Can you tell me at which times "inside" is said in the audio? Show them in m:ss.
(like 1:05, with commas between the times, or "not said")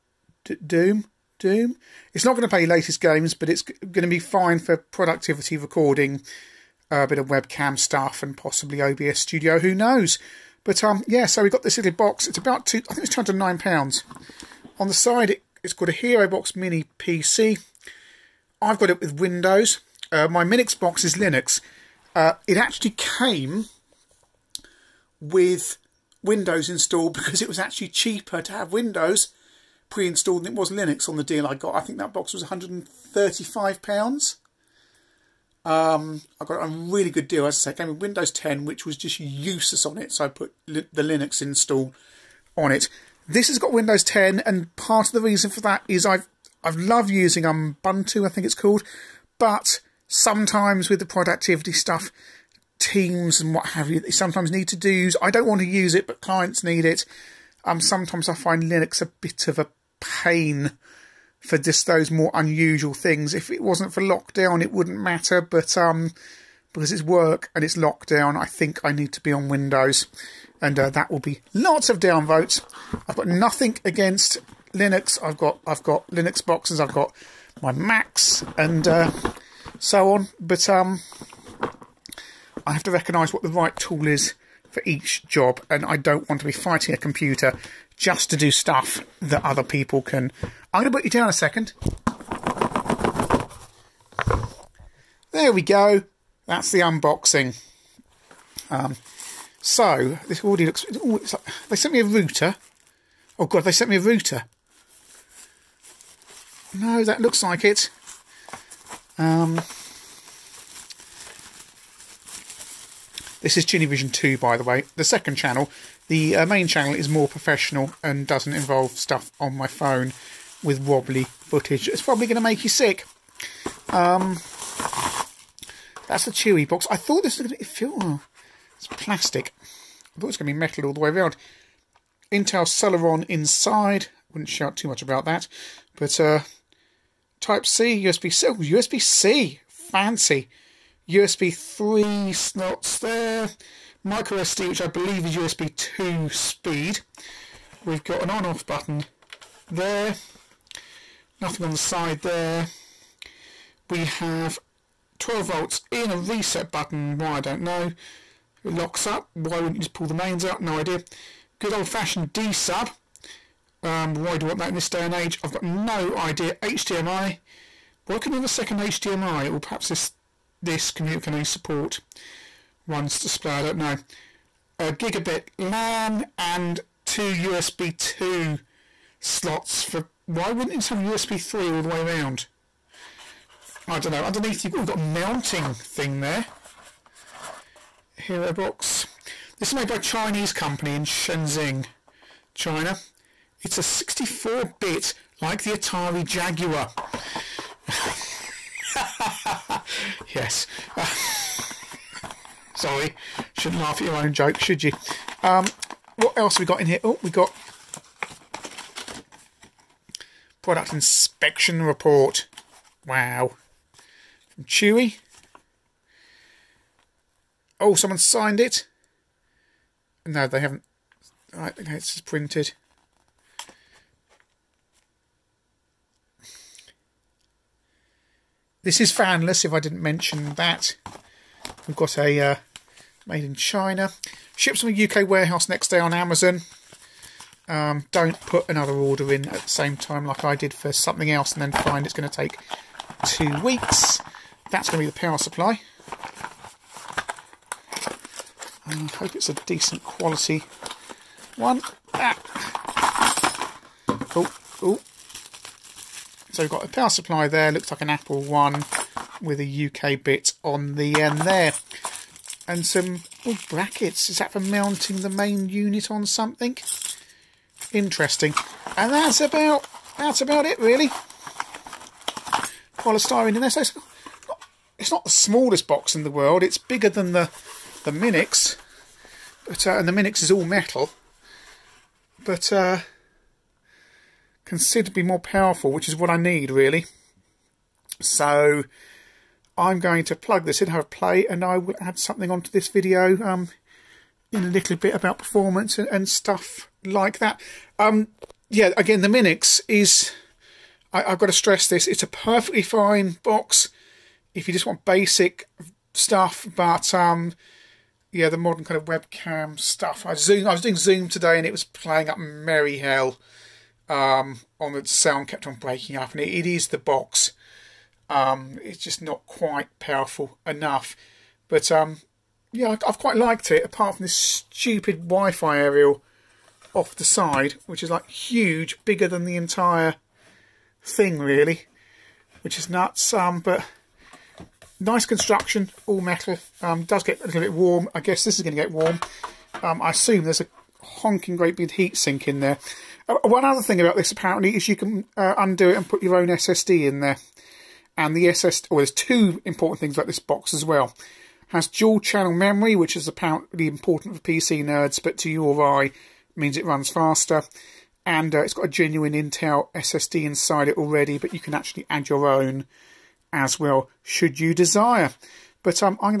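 2:13, 6:00.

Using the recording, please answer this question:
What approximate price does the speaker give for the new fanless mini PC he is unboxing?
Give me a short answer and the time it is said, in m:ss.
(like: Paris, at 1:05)
£209, at 0:13.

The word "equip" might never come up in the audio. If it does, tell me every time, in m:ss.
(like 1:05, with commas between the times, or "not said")
not said.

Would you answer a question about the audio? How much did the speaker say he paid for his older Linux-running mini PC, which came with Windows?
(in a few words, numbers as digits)
£135.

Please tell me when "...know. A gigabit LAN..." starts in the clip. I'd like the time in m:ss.
2:53.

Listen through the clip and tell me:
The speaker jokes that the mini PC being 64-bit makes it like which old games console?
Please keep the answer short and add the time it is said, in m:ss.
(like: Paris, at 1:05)
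Atari Jaguar, at 3:15.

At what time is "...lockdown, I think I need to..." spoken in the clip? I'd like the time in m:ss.
1:07.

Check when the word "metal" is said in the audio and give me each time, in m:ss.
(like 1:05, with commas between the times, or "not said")
2:10, 4:40, 5:36.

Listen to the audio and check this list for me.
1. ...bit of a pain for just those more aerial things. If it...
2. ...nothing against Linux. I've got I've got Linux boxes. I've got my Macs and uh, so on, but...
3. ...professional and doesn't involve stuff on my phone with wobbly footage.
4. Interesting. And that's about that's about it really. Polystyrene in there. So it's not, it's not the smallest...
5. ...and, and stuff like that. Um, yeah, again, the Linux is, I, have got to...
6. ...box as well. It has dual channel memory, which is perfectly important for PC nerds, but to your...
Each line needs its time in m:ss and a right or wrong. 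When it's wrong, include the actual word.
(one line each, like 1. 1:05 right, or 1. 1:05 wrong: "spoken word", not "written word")
1. 0:59 wrong: "unusual", not "aerial"
2. 1:13 right
3. 1:57 right
4. 4:27 right
5. 4:55 wrong: "Minix", not "Linux"
6. 5:50 wrong: "apparently", not "perfectly".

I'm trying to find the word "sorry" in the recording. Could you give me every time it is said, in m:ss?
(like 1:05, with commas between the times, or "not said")
3:22.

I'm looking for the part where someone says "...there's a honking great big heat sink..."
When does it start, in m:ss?
5:40.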